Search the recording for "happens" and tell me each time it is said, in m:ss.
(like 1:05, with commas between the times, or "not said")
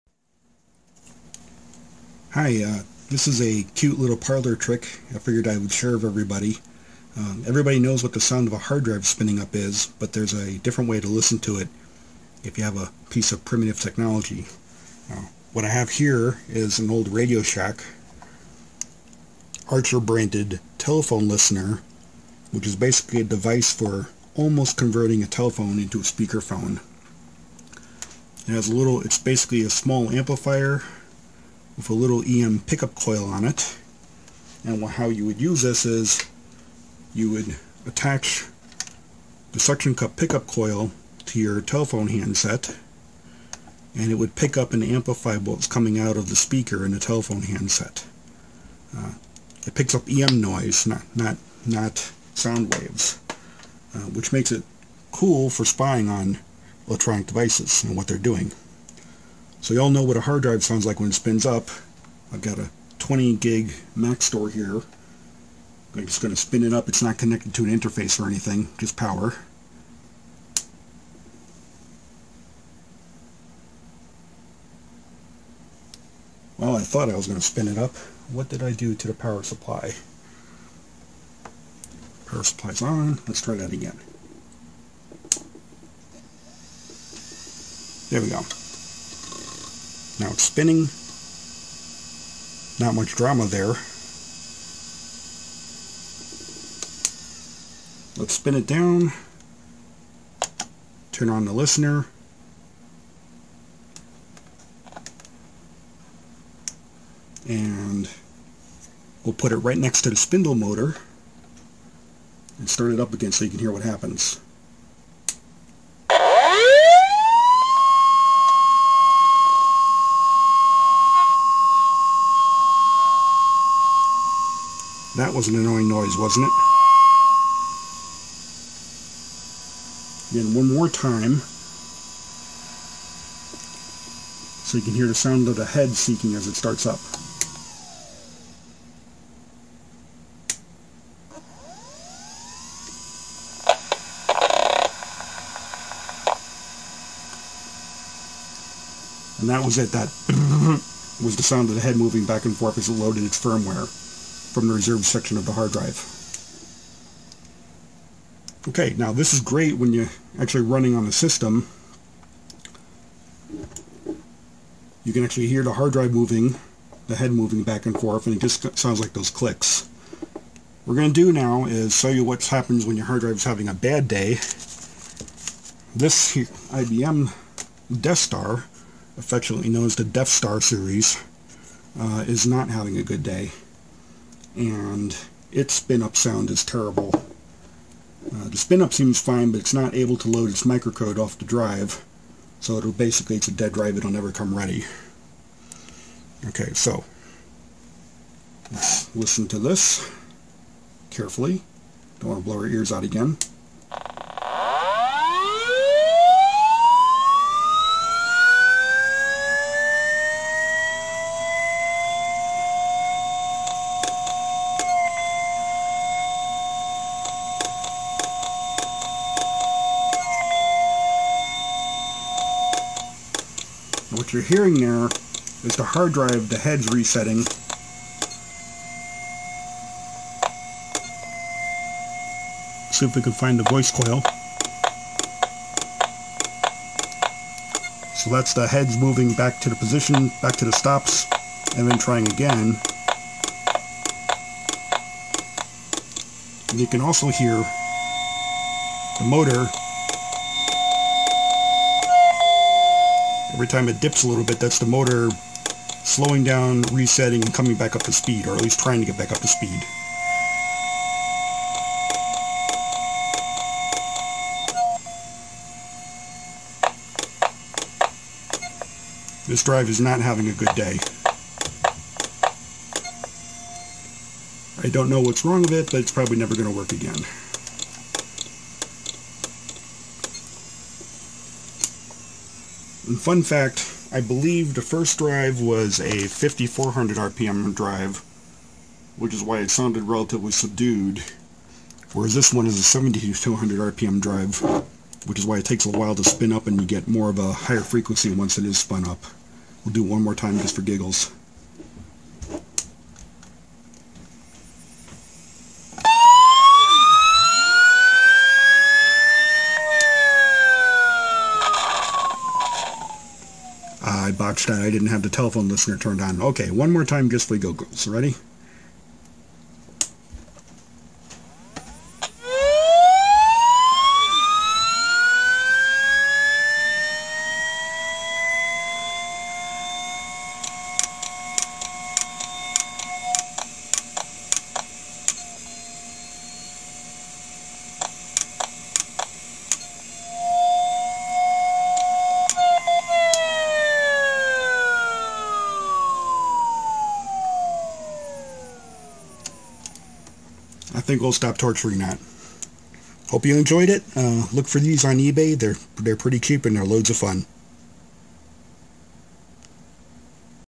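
1:53, 2:52.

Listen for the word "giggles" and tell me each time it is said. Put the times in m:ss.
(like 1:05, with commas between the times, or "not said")
5:00, 5:17.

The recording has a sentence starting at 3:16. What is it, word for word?
Okay, so, let's listen to this carefully.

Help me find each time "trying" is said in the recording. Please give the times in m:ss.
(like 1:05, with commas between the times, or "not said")
4:01, 4:18.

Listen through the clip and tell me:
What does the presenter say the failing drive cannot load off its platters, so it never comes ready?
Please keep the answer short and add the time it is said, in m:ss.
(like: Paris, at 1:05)
microcode, at 3:10.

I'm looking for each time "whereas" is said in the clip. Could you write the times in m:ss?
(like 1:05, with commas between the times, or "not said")
4:52.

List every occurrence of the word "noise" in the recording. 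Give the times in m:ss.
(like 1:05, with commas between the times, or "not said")
0:50, 2:05.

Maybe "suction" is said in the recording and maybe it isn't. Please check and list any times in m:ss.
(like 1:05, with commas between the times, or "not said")
0:39.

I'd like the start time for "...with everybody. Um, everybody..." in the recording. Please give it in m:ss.
0:05.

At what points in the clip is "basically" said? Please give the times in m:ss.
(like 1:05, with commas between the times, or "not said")
0:22, 0:29, 3:12.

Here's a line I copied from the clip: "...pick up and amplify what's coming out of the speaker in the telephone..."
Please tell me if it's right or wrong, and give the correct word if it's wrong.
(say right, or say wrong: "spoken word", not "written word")
right.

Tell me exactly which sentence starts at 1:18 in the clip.
What did I do to the power supply?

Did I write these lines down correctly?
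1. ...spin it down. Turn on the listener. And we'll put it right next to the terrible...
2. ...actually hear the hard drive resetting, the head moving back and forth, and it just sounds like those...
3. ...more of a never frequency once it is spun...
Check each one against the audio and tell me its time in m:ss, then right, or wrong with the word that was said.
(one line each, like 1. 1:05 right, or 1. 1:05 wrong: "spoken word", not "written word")
1. 1:38 wrong: "spindle", not "terrible"
2. 2:45 wrong: "moving", not "resetting"
3. 4:57 wrong: "higher", not "never".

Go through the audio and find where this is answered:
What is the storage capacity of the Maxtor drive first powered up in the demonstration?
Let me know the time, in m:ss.
1:02.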